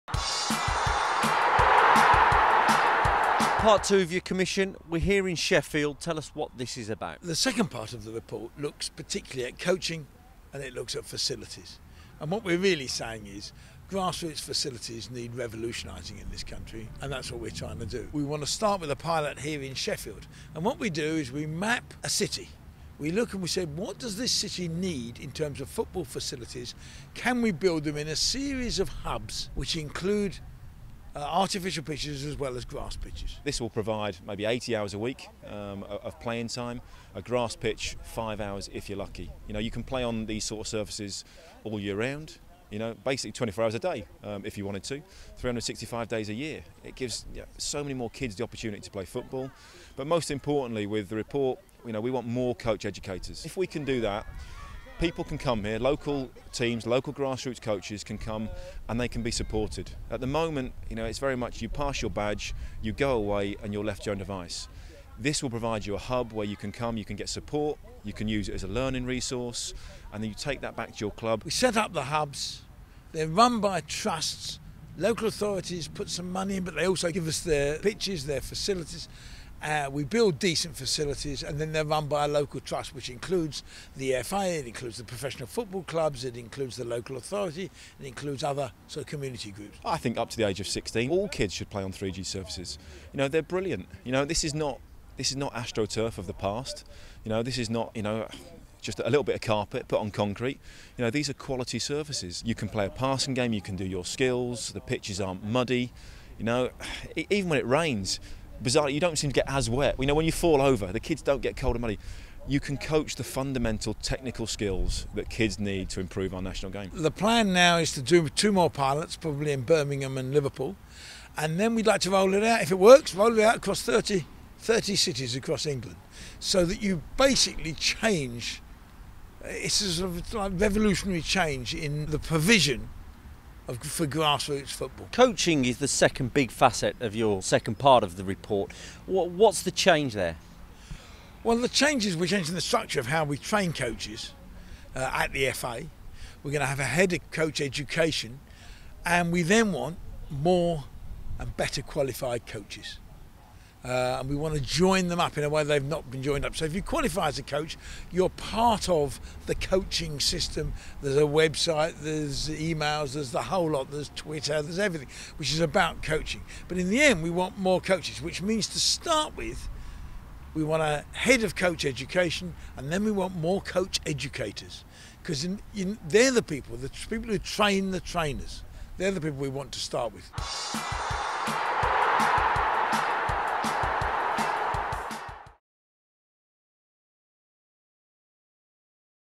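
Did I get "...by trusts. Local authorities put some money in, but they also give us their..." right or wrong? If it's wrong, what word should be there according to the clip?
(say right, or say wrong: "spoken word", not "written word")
right.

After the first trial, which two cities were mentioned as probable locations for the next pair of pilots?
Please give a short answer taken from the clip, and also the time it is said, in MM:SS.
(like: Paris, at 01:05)
Birmingham and Liverpool, at 01:59.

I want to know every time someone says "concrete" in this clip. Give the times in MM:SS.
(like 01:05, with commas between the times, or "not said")
01:40.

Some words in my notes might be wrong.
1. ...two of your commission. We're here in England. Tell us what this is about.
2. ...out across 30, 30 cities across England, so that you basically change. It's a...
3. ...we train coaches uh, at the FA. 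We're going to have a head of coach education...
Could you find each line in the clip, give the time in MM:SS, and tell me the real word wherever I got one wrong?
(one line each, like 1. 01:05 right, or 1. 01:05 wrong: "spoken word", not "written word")
1. 00:03 wrong: "Sheffield", not "England"
2. 02:03 right
3. 02:23 right.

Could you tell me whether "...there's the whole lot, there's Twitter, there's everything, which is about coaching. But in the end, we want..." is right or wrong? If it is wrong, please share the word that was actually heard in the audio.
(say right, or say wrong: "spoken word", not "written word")
right.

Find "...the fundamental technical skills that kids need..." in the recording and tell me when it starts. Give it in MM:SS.
01:53.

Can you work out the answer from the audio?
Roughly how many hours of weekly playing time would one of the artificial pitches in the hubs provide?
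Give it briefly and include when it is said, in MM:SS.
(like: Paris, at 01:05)
80 hours, at 00:34.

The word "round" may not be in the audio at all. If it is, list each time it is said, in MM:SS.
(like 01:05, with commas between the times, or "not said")
00:41.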